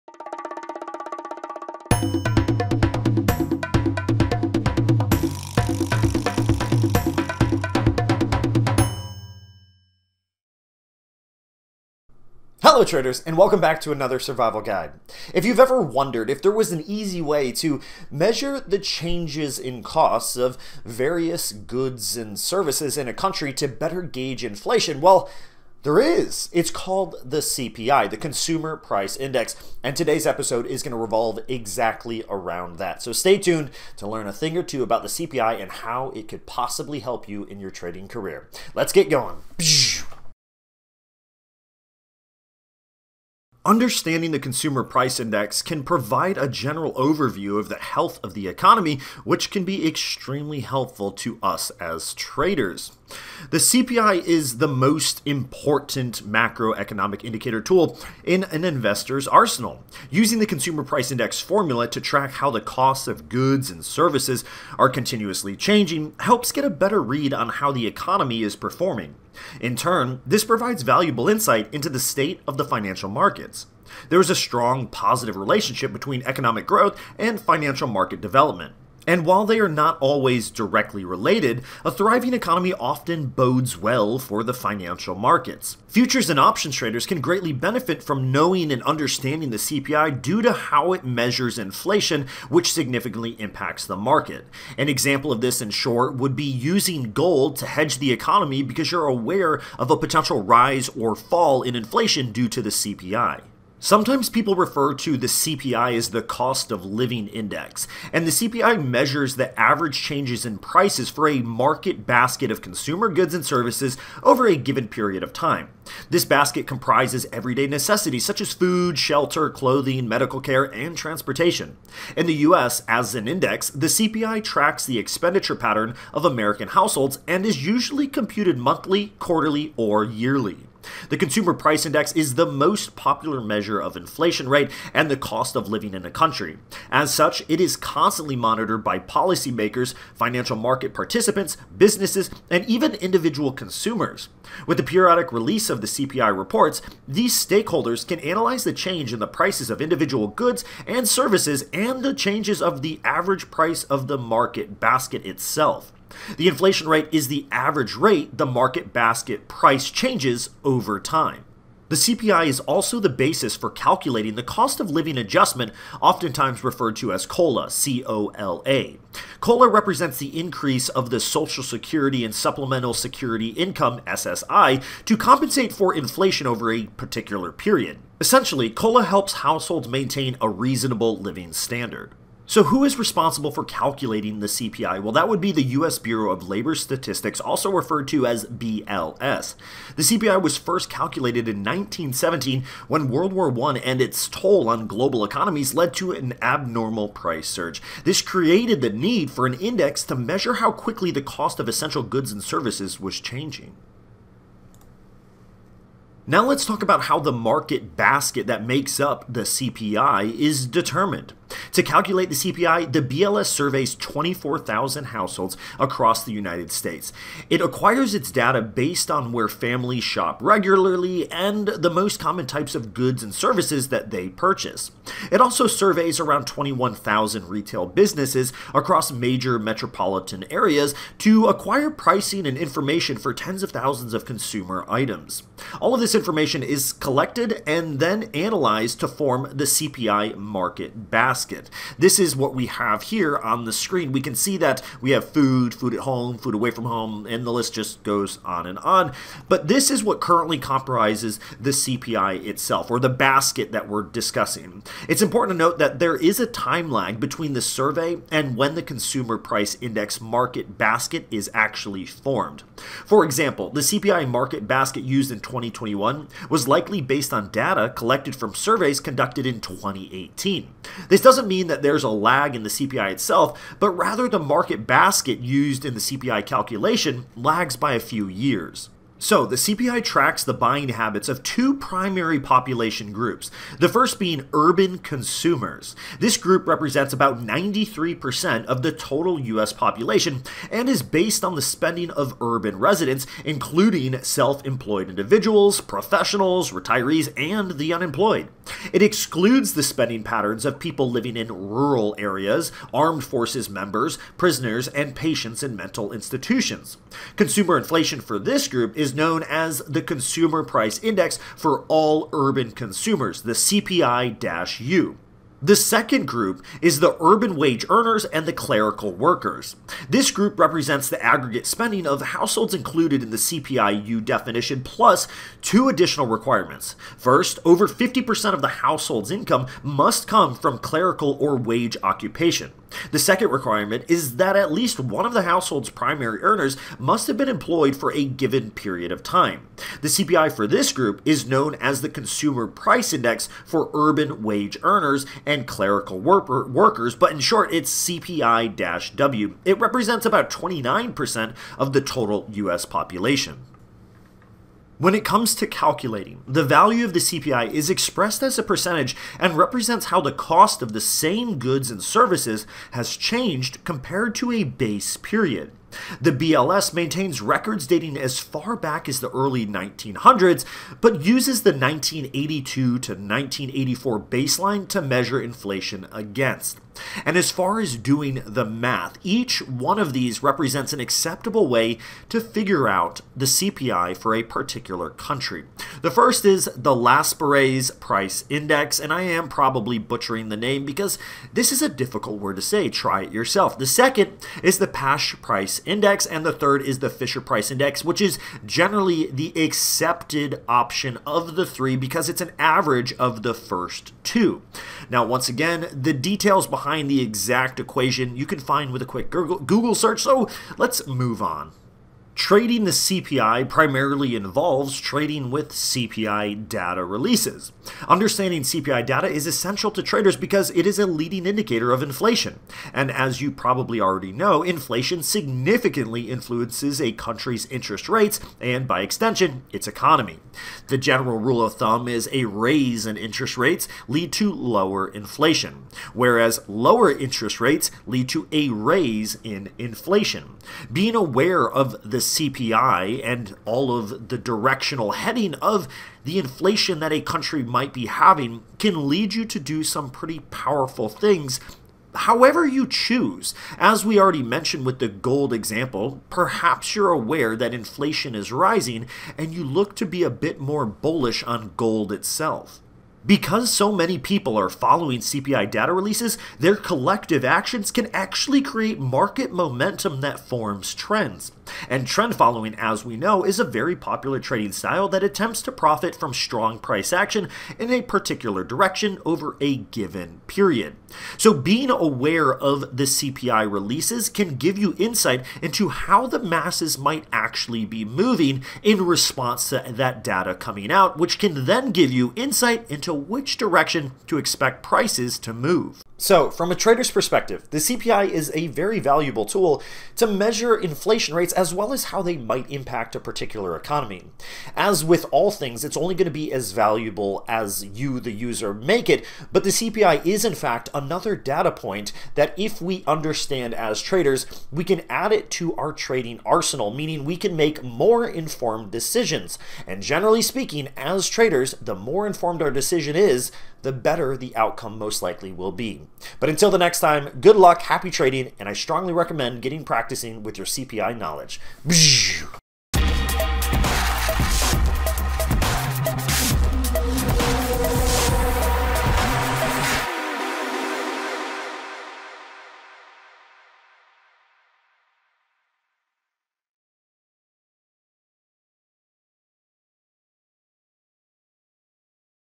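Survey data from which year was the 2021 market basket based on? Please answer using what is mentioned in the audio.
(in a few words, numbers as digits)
2018.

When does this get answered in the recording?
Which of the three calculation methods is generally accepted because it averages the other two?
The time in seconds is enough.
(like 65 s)
397 s.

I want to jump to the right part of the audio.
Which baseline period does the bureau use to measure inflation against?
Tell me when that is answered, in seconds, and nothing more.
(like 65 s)
371 s.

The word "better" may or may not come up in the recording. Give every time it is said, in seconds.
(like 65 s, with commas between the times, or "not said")
23 s, 66 s, 523 s.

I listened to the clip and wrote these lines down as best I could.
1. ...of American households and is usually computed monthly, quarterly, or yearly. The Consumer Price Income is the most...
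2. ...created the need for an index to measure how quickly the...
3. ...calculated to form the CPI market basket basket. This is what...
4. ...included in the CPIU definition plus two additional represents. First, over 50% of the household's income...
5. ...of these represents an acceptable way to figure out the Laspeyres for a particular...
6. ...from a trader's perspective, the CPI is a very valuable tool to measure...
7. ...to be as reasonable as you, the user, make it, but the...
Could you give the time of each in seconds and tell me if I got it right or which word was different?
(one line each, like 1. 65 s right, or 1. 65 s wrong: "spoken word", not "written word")
1. 126 s wrong: "Index", not "Income"
2. 198 s right
3. 238 s wrong: "analyzed", not "calculated"
4. 322 s wrong: "requirements", not "represents"
5. 379 s wrong: "CPI", not "Laspeyres"
6. 496 s right
7. 506 s wrong: "valuable", not "reasonable".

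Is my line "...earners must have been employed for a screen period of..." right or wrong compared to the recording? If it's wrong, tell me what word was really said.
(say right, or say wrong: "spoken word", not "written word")
wrong: "given", not "screen".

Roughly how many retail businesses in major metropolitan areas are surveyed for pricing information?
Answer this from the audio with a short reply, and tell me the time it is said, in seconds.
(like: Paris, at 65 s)
21,000, at 226 s.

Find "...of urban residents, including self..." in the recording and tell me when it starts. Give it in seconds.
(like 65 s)
292 s.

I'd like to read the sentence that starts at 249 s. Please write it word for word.
But this is what currently comprises the CPI itself, or the basket that we're discussing.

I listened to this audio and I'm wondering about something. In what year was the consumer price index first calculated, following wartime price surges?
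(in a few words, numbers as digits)
1917.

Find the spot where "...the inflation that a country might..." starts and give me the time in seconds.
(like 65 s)
446 s.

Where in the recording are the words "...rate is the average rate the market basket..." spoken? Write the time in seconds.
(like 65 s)
156 s.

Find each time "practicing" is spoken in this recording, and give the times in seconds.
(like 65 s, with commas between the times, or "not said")
529 s.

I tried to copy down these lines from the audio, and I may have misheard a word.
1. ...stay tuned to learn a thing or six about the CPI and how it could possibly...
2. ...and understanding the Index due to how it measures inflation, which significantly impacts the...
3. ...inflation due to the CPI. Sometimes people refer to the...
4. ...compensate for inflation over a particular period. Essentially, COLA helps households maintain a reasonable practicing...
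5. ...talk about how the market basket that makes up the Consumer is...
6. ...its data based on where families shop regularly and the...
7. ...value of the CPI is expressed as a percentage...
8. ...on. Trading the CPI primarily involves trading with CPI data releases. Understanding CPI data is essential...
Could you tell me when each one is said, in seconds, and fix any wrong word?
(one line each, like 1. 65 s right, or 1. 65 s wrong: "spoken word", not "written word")
1. 33 s wrong: "two", not "six"
2. 88 s wrong: "CPI", not "Index"
3. 101 s right
4. 175 s wrong: "living", not "practicing"
5. 206 s wrong: "CPI", not "Consumer"
6. 218 s right
7. 356 s right
8. 411 s right.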